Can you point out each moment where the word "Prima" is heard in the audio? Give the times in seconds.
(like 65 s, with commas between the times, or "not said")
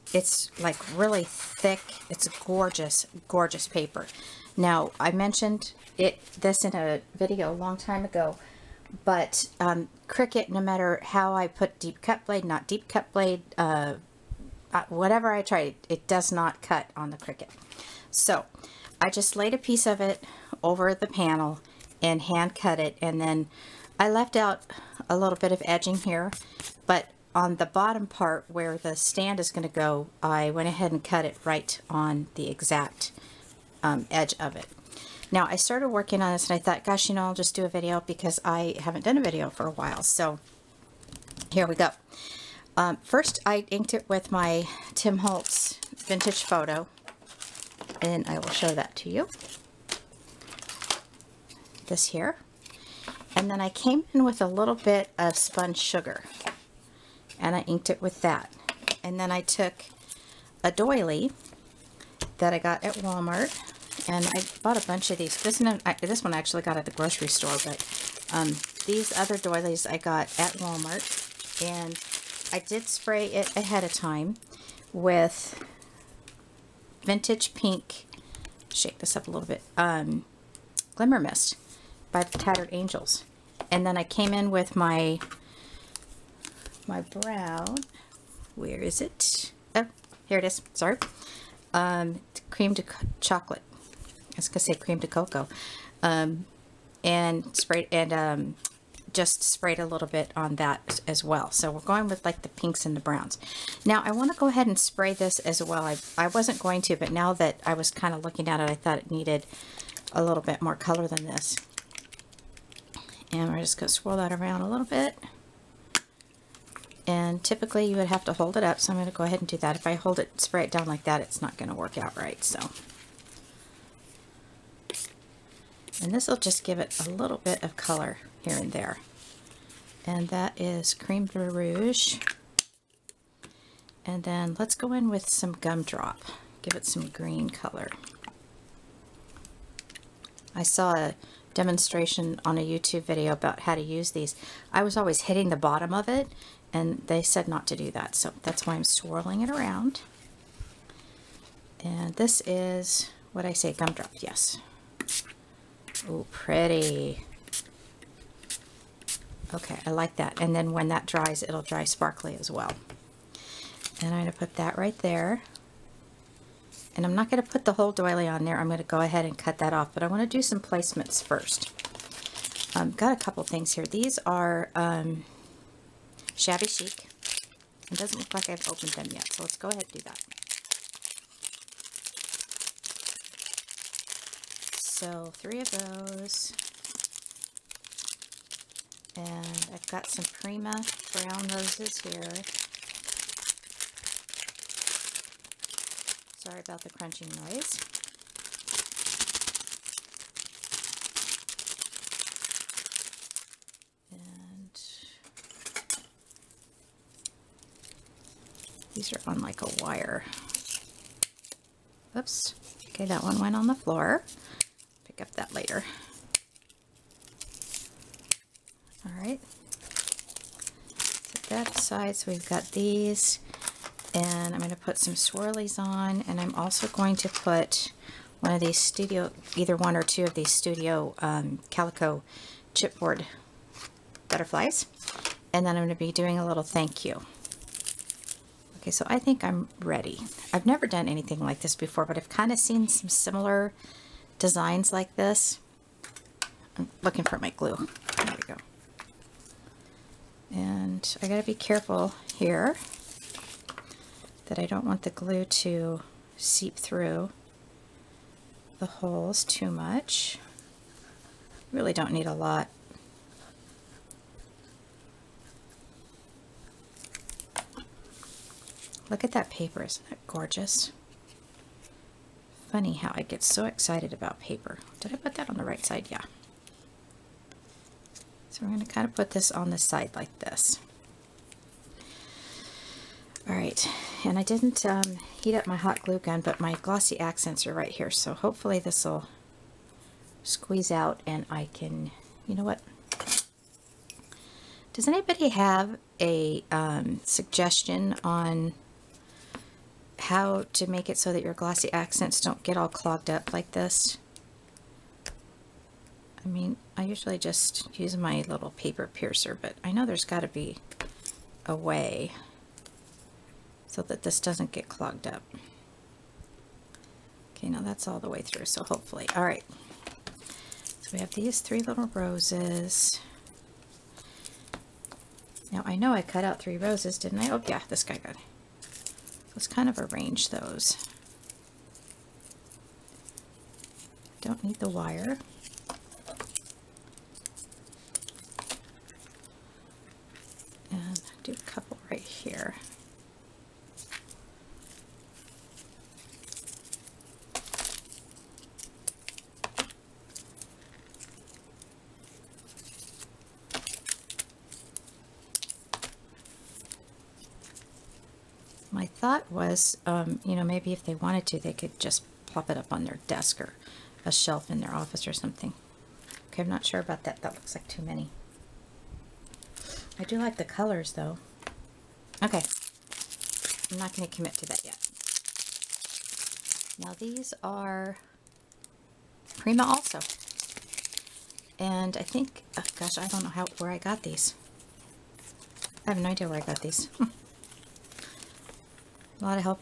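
190 s, 379 s.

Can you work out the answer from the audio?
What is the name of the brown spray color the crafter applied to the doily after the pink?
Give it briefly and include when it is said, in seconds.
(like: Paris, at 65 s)
Cream to chocolate, at 92 s.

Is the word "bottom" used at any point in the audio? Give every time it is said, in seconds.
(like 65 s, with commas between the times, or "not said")
27 s, 145 s.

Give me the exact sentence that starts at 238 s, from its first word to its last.
Okay, so I think I'm ready.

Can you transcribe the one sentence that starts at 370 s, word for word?
I do like the colors, though.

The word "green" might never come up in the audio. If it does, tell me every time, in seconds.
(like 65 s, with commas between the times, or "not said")
137 s.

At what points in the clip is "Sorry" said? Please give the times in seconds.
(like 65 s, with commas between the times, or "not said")
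90 s, 196 s.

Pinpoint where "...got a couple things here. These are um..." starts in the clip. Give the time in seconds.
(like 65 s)
172 s.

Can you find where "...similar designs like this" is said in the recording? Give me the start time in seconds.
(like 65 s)
243 s.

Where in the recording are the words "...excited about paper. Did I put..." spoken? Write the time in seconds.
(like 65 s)
273 s.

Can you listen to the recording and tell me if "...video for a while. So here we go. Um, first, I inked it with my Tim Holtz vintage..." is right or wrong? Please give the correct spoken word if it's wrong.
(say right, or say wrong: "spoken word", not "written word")
right.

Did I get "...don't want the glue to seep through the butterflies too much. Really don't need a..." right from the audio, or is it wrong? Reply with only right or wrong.
wrong.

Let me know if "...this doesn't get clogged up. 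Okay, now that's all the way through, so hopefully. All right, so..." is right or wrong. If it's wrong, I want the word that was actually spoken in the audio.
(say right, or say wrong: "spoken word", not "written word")
right.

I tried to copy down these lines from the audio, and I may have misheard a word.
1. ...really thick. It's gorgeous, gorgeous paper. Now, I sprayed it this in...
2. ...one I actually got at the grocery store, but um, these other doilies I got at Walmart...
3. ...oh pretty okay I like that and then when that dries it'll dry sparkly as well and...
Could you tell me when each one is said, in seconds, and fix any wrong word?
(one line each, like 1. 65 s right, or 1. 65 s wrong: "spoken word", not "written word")
1. 0 s wrong: "mentioned", not "sprayed"
2. 66 s right
3. 156 s right.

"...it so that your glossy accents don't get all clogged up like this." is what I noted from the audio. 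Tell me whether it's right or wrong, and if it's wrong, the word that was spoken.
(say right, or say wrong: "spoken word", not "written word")
right.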